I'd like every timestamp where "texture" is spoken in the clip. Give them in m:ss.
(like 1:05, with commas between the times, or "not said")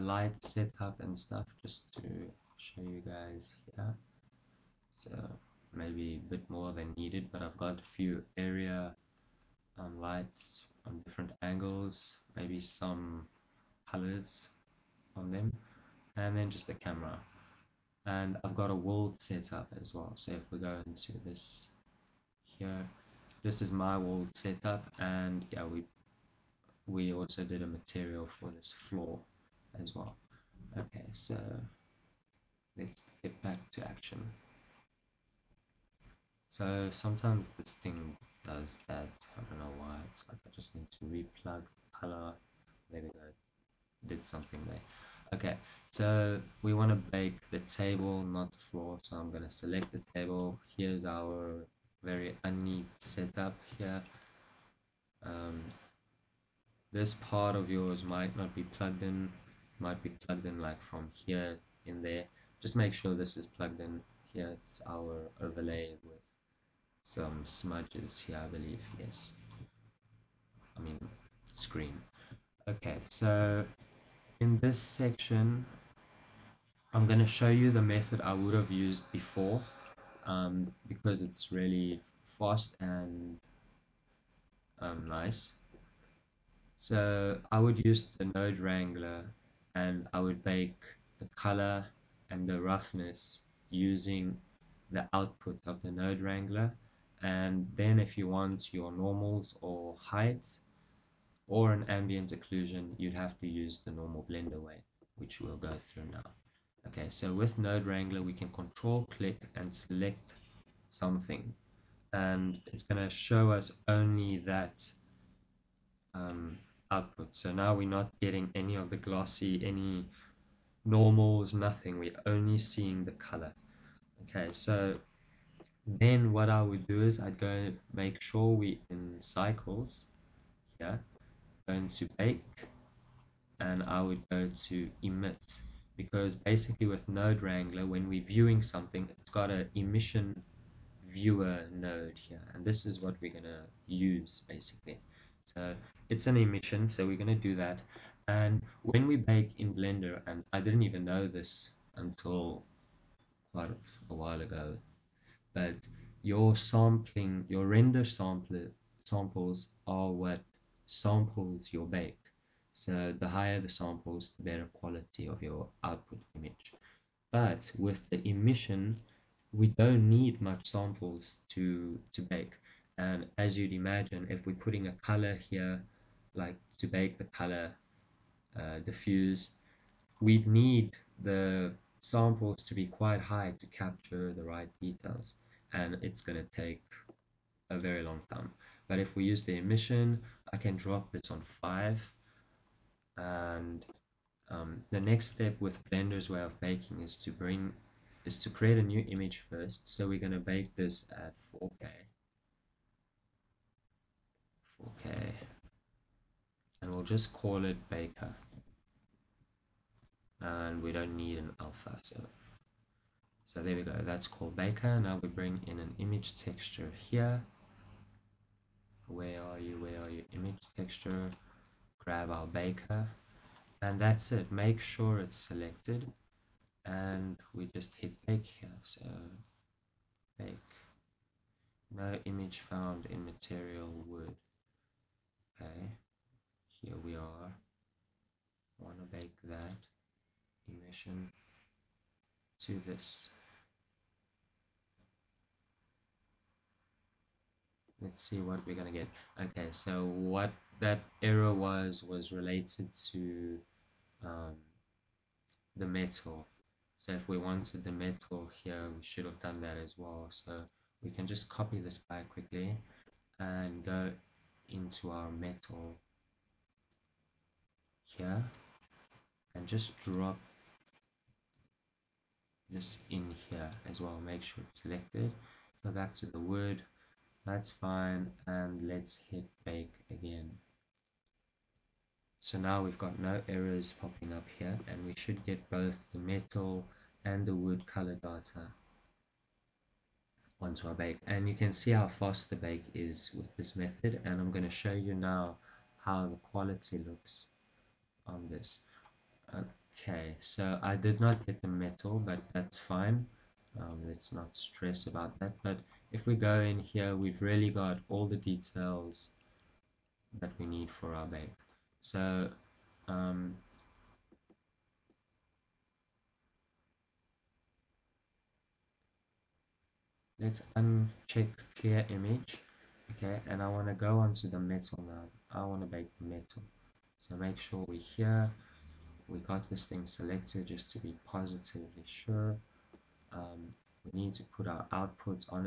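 3:36, 3:40.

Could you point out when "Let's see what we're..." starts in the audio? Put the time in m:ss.
4:07.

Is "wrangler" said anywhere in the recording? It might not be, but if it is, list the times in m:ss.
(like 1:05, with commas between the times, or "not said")
1:28, 1:36, 1:47, 2:17.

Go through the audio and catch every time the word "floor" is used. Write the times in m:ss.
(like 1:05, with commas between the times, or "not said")
0:28, 0:48.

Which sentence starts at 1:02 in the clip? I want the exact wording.
Just make sure this is plugged in here.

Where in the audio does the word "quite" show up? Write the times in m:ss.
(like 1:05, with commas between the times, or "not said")
2:33, 3:02.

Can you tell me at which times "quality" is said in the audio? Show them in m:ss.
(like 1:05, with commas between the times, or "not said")
2:44, 4:56.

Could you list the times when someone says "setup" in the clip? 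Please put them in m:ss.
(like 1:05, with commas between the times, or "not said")
0:00, 0:24, 0:52.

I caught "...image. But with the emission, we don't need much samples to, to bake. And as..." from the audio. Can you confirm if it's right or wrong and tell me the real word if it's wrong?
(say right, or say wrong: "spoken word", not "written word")
right.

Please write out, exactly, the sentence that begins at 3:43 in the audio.
And that's it, make sure it's selected.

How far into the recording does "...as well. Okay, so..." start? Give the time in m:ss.
0:29.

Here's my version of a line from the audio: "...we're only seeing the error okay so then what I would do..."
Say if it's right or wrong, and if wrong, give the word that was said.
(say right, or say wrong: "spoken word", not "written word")
wrong: "color", not "error".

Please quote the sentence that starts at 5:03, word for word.
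Um, let's not stress about that.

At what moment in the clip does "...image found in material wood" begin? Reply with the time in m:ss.
3:52.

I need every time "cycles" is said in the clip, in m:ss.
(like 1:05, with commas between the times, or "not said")
2:09.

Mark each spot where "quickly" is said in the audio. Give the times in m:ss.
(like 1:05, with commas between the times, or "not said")
4:22.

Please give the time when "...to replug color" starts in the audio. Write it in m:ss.
0:40.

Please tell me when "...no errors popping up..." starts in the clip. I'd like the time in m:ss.
4:43.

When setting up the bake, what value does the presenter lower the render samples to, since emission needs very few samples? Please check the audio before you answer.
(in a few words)
5.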